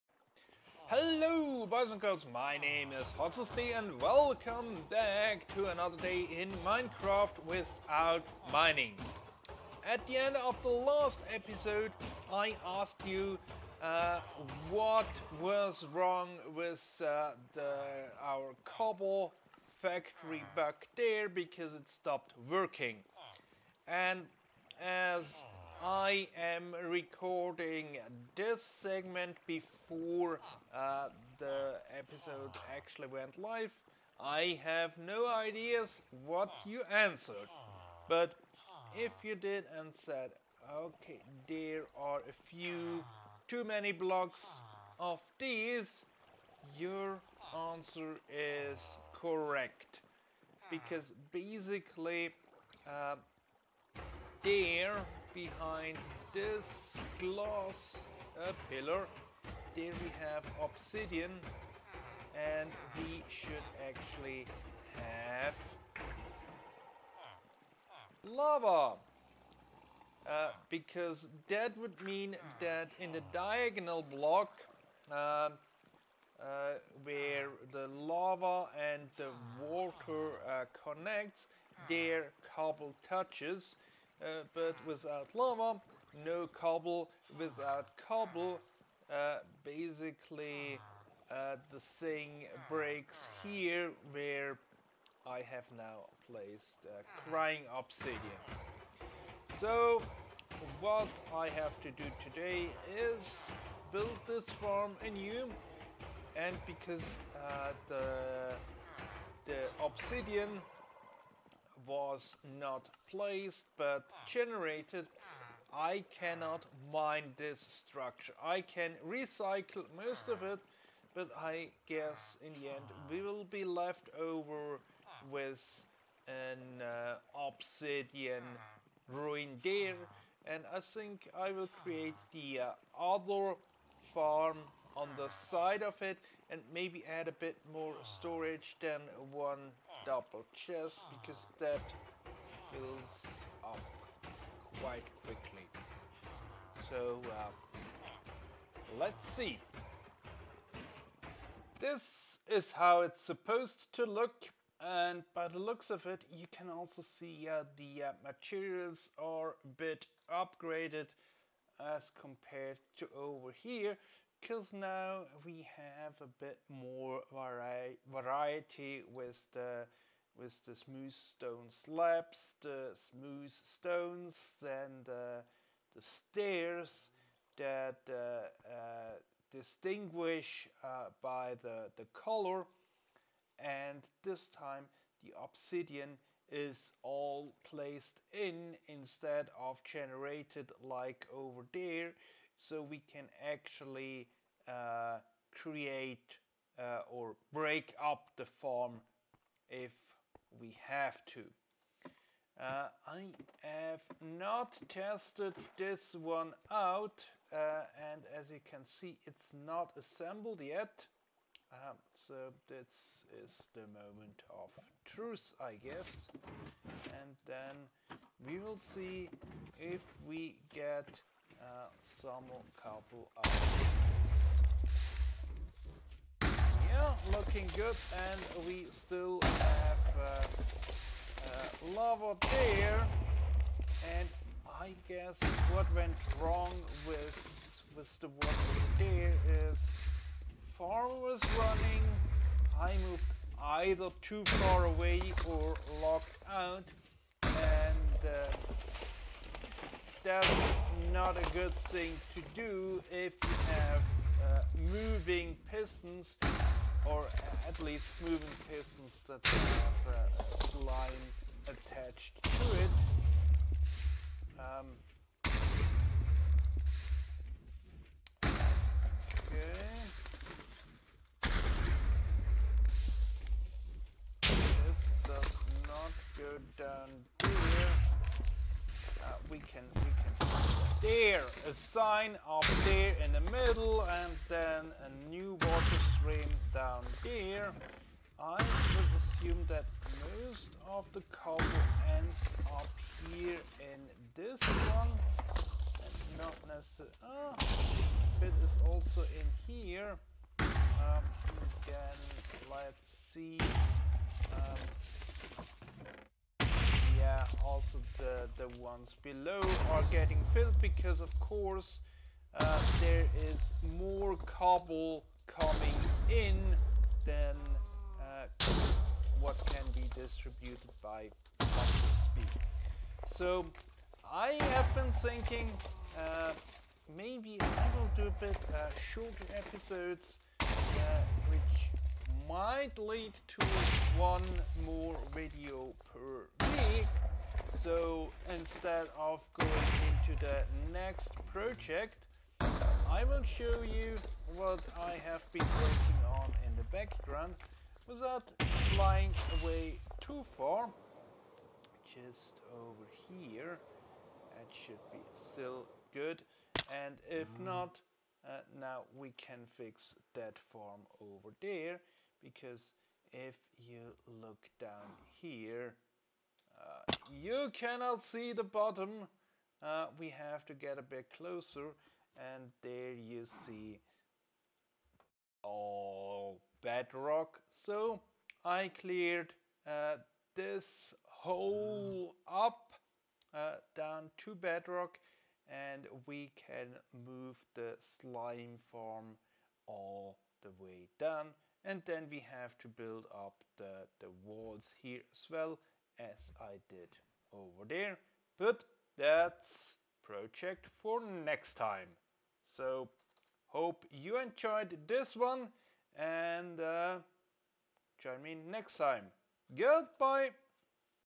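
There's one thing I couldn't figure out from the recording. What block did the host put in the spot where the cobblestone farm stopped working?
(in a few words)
Crying Obsidian.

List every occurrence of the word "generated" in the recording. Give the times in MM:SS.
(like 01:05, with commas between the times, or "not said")
01:54, 03:09.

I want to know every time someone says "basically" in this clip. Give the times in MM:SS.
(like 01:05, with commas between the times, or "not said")
00:51, 01:29.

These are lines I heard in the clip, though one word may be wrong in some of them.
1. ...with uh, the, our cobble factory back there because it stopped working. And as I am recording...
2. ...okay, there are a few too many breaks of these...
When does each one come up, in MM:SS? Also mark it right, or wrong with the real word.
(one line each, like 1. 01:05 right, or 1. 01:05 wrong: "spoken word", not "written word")
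1. 00:16 right
2. 00:40 wrong: "blocks", not "breaks".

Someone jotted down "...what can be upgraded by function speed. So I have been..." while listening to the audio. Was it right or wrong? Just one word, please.
wrong.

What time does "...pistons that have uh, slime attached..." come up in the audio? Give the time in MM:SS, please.
04:18.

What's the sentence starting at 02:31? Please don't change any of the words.
This is how it's supposed to look.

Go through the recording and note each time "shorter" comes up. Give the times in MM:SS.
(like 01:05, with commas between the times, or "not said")
05:29.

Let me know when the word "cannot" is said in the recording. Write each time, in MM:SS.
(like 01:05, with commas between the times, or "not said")
01:56, 06:07.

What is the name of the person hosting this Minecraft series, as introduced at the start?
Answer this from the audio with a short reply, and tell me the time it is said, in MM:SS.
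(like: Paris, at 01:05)
Hotzst, at 00:03.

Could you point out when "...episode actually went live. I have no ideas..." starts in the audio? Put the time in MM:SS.
00:31.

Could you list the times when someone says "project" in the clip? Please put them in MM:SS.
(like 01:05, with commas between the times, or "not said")
05:41, 06:40.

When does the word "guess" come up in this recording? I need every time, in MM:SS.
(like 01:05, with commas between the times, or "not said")
02:01, 03:35, 03:55.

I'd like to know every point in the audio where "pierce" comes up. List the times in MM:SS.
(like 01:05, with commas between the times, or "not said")
not said.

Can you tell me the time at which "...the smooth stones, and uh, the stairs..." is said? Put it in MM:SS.
02:52.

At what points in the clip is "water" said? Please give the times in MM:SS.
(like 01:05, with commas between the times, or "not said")
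01:19, 03:58, 04:45.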